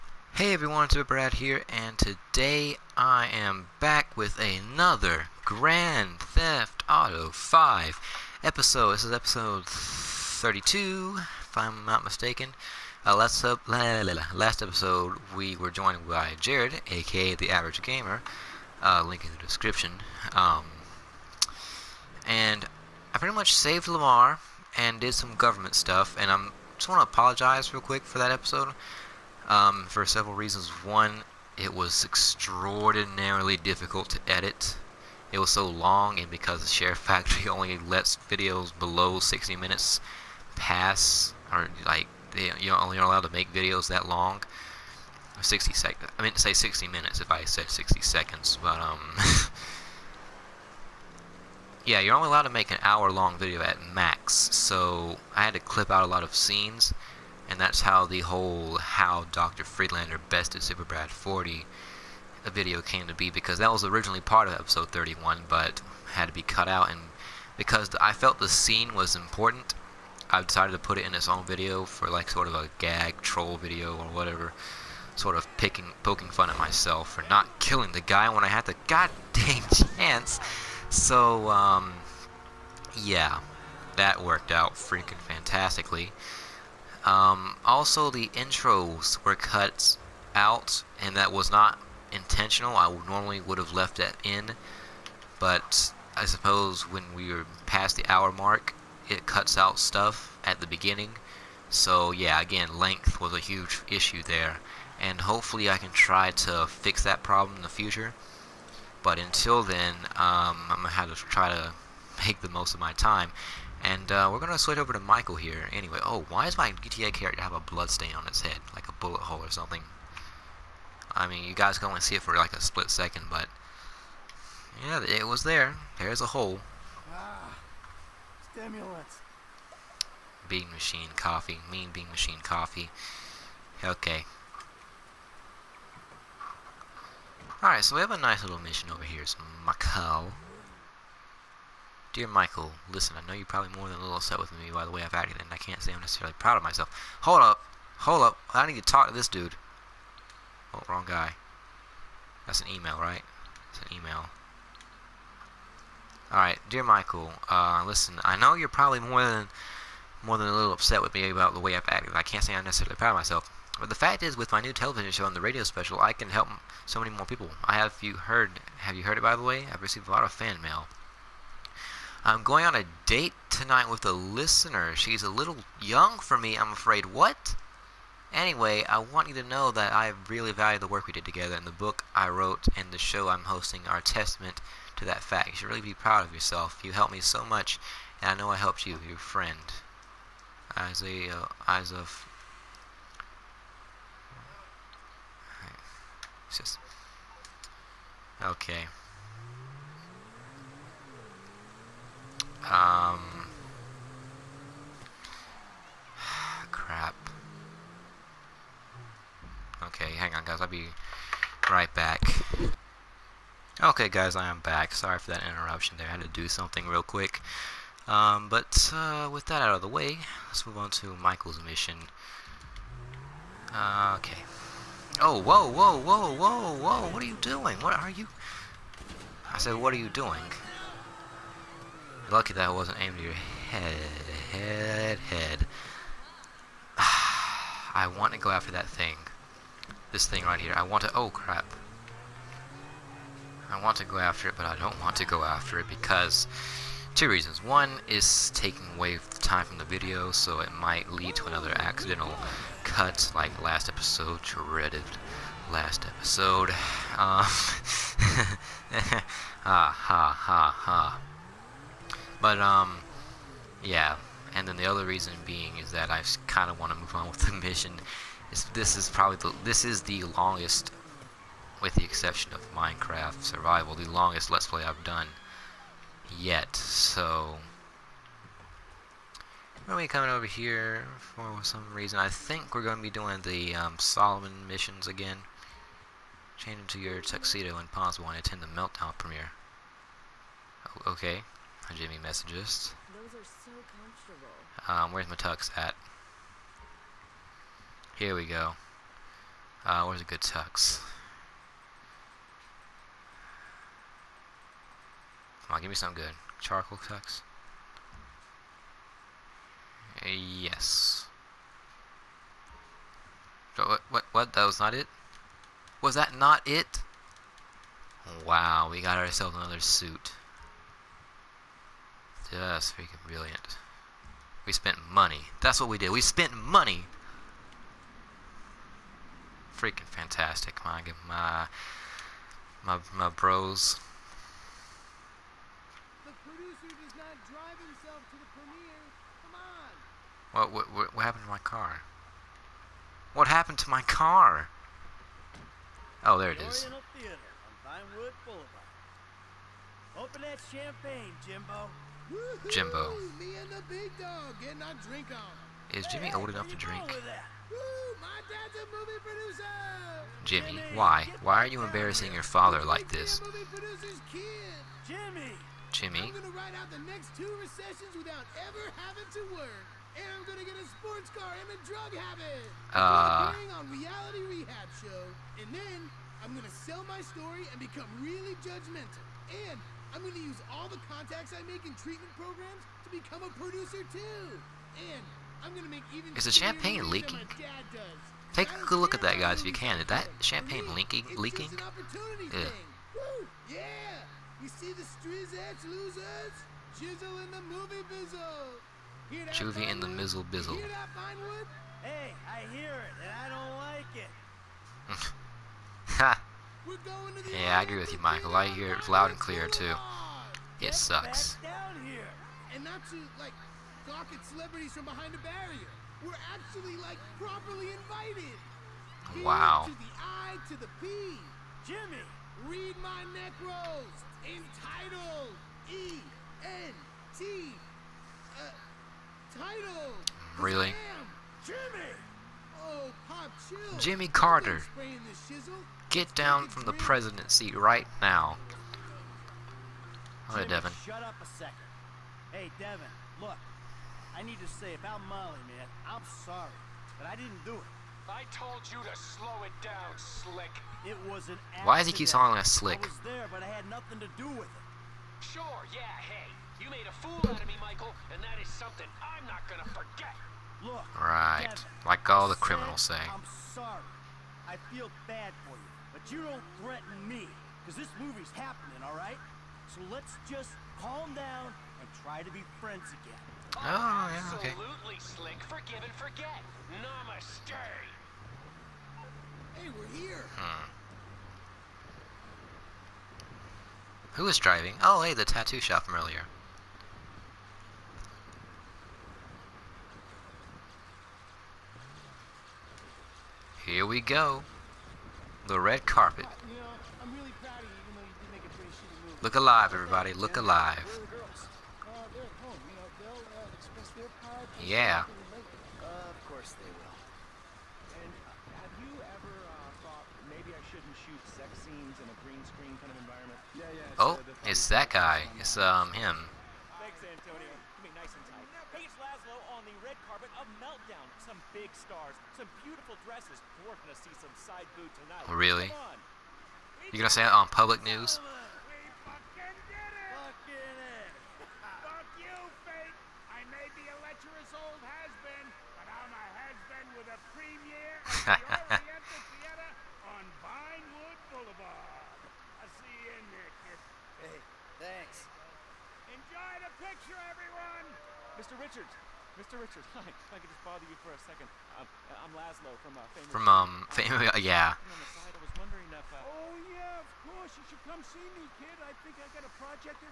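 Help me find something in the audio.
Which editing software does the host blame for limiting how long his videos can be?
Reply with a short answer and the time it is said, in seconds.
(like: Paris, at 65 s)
SHAREfactory, at 36 s.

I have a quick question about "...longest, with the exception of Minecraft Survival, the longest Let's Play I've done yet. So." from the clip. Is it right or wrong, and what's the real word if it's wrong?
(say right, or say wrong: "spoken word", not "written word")
right.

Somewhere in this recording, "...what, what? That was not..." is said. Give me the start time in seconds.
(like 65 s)
314 s.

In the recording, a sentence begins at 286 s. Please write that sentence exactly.
Change into your tuxedo and possible and attend the Meltdown premiere.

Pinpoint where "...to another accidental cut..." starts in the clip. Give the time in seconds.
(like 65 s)
251 s.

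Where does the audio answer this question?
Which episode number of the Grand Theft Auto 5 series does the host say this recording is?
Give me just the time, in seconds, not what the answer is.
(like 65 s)
9 s.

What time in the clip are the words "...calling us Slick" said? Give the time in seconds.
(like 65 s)
452 s.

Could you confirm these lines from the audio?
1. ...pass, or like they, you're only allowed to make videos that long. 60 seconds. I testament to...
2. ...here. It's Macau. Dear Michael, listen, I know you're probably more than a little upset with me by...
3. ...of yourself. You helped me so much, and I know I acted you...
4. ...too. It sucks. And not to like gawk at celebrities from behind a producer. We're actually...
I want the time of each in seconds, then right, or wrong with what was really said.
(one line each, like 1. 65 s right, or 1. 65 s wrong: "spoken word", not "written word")
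1. 40 s wrong: "meant", not "testament"
2. 139 s right
3. 186 s wrong: "helped", not "acted"
4. 409 s wrong: "barrier", not "producer".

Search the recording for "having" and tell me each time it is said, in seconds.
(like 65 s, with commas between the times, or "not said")
not said.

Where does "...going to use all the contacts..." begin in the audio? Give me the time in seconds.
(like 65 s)
380 s.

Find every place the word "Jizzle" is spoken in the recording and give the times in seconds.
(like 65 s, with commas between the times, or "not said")
396 s.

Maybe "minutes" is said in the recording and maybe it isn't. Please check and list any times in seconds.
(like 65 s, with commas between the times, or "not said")
39 s, 46 s.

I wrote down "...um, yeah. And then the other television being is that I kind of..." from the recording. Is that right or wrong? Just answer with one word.
wrong.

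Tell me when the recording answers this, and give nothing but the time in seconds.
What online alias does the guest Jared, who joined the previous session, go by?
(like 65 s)
17 s.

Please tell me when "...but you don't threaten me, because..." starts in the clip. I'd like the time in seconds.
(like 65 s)
466 s.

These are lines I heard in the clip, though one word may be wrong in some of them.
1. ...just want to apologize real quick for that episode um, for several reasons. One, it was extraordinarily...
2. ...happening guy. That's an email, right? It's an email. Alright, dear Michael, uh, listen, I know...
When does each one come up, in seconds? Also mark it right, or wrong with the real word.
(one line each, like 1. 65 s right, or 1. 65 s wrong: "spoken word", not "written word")
1. 26 s right
2. 150 s wrong: "wrong", not "happening".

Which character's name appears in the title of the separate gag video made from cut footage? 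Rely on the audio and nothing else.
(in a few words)
Dr. Friedlander.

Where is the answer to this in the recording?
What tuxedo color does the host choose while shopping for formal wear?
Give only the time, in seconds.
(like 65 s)
306 s.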